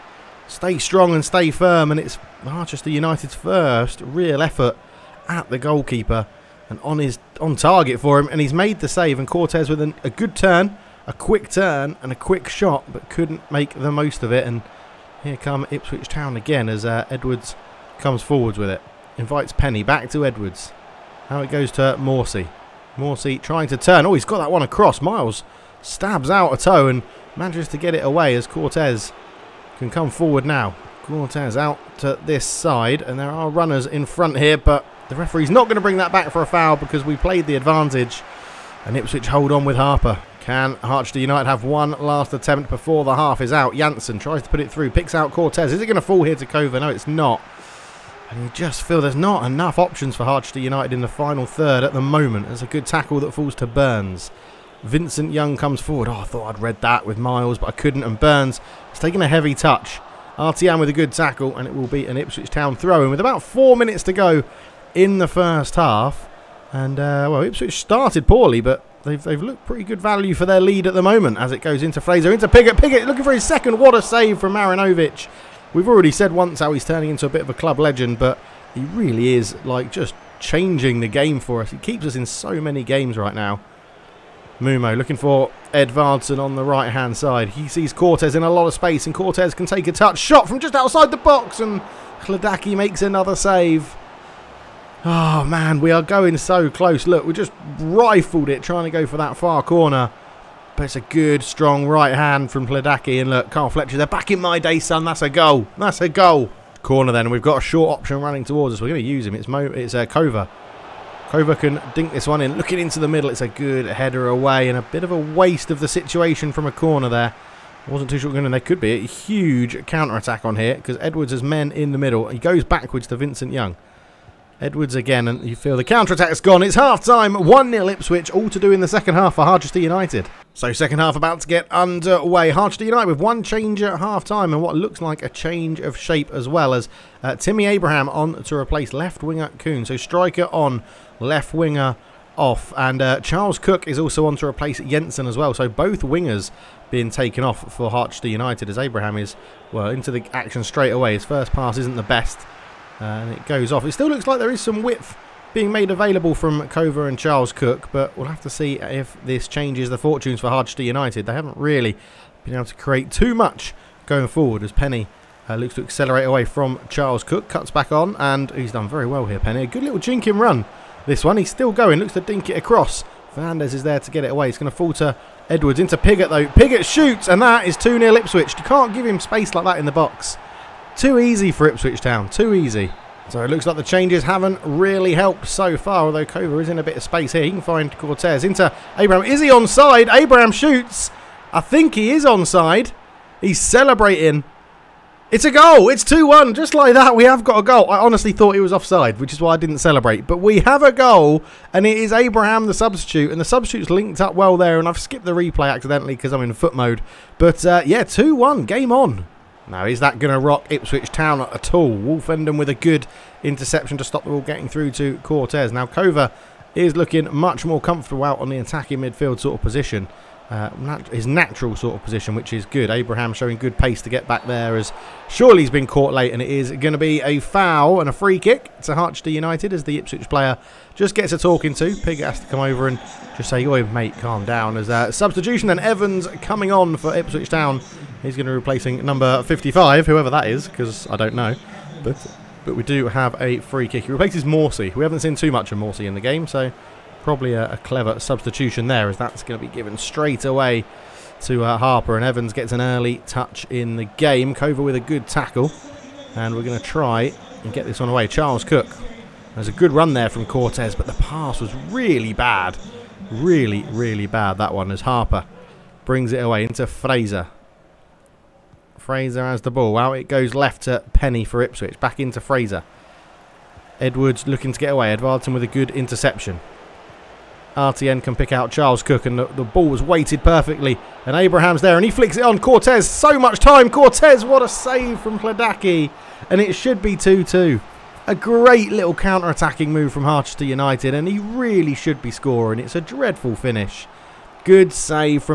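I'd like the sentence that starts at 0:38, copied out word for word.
And Ipswich hold on with Harper.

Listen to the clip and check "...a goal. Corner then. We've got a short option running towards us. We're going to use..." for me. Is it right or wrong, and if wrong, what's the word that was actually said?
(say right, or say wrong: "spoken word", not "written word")
right.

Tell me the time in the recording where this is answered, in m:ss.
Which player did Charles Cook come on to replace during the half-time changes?
2:24.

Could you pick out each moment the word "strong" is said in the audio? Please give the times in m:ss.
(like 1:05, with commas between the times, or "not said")
0:00, 1:41.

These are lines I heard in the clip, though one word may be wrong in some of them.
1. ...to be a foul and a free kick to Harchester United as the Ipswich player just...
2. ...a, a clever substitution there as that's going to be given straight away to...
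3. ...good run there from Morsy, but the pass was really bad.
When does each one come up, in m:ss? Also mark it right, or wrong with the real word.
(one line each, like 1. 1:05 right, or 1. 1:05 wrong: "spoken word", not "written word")
1. 3:46 right
2. 4:07 right
3. 4:19 wrong: "Cortez", not "Morsy".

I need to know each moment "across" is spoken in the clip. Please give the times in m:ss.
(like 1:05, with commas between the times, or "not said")
0:24, 2:52.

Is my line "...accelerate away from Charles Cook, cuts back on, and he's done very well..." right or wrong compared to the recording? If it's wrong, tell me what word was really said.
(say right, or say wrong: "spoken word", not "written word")
right.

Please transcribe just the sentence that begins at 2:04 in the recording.
Edwards again, and you feel the counter-attack's gone.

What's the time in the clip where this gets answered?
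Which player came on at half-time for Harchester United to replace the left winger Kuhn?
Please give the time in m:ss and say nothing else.
2:17.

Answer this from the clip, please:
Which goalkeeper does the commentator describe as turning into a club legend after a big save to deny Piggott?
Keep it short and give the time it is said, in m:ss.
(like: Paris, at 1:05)
Marinovic, at 1:14.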